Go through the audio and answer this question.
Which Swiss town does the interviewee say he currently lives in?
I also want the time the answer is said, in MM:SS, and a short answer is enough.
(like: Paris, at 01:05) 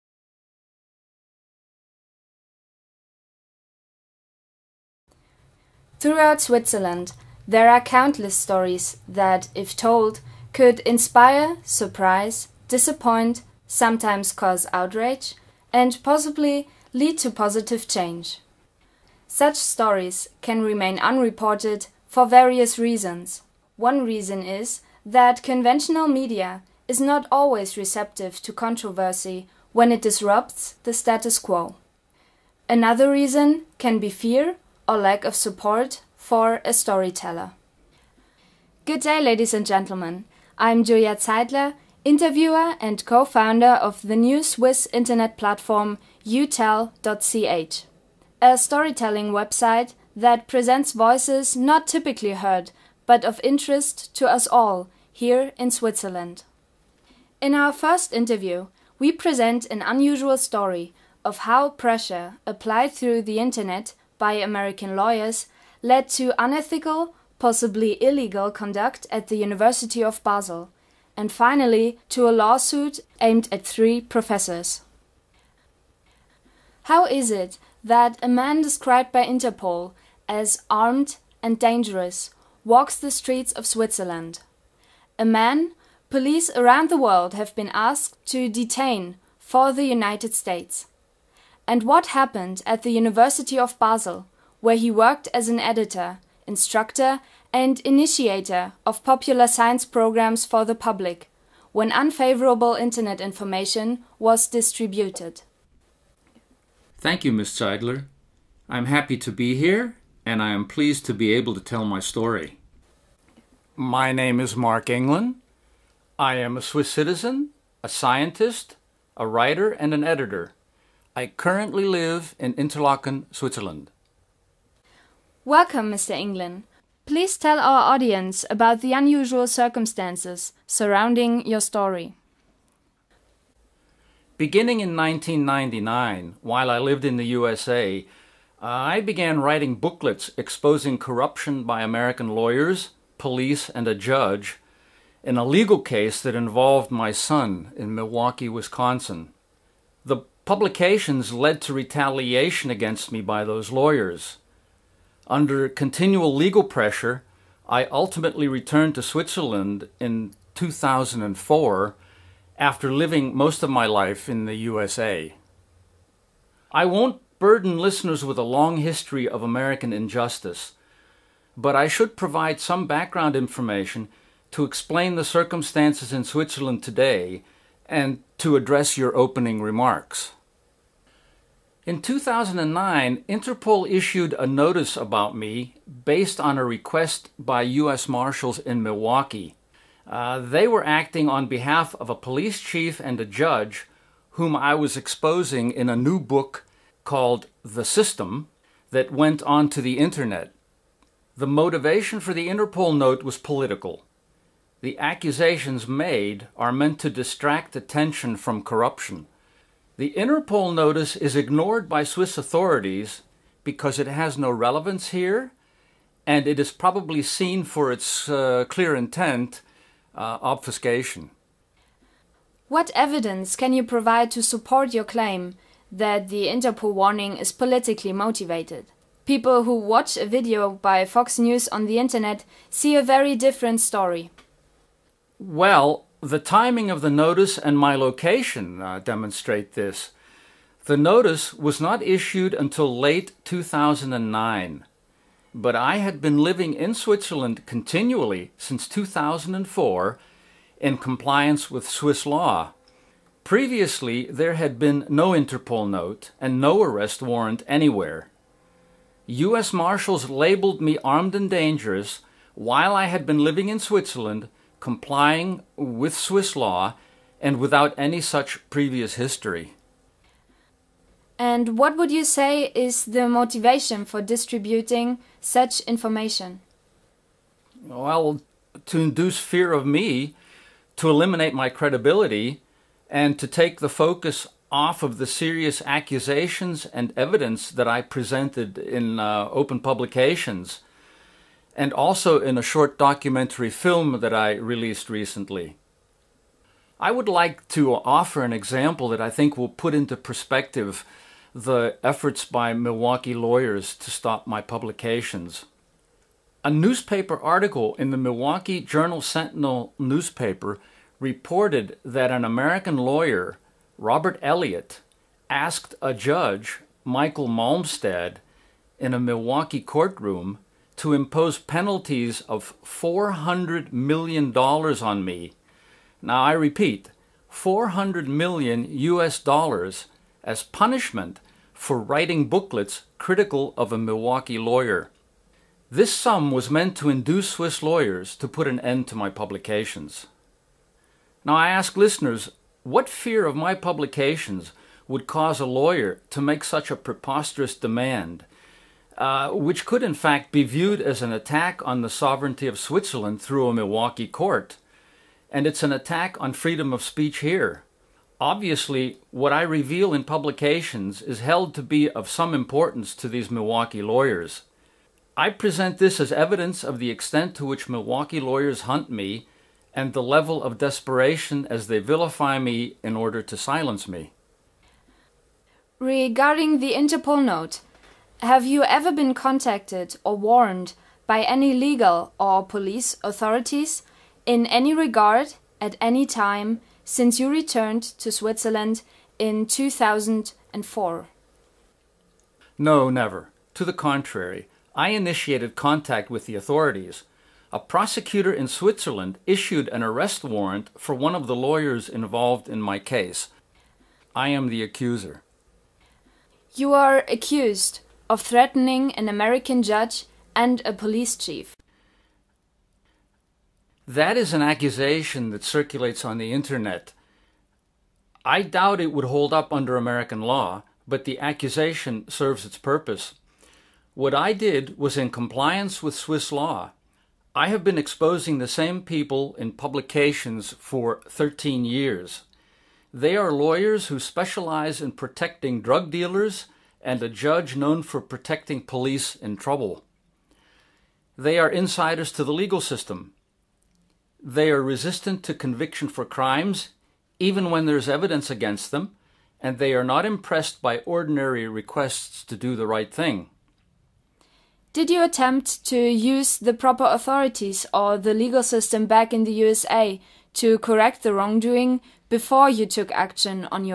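Interlaken, at 02:02.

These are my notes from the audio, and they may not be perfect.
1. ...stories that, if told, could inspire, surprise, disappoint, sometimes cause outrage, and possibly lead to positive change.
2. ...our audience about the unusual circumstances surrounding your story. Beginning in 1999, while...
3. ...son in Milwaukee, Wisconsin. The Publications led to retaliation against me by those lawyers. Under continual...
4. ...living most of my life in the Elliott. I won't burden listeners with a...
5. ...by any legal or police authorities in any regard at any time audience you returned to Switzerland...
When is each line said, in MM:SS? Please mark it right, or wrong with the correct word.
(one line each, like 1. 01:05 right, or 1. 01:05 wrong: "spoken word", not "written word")
1. 00:08 right
2. 02:07 right
3. 02:27 right
4. 02:42 wrong: "USA", not "Elliott"
5. 06:21 wrong: "since", not "audience".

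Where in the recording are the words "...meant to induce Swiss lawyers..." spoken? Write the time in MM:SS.
05:36.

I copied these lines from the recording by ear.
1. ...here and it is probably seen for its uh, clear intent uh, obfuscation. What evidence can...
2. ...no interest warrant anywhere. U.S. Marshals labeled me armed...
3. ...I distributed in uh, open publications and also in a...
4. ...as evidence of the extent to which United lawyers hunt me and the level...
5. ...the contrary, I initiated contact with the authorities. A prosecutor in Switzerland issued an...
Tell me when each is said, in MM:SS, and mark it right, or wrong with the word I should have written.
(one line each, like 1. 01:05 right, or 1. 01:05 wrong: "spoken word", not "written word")
1. 03:35 right
2. 04:16 wrong: "arrest", not "interest"
3. 04:47 wrong: "presented", not "distributed"
4. 06:06 wrong: "Milwaukee", not "United"
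5. 06:33 right.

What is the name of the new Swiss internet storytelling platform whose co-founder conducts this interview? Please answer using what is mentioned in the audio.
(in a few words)
utell.ch.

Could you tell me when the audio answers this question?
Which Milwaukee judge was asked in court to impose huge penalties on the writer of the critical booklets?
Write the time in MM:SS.
05:17.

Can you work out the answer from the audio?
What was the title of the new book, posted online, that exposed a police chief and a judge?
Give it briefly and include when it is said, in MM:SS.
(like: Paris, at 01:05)
The System, at 03:17.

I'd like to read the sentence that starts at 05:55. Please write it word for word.
And it's an attack on freedom of speech here.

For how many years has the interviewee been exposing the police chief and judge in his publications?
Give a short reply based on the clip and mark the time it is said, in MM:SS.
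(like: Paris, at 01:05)
13 years, at 07:11.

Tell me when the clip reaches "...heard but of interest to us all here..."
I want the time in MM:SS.
00:52.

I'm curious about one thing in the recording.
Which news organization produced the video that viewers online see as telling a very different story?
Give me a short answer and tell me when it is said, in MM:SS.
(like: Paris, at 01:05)
Fox News, at 03:51.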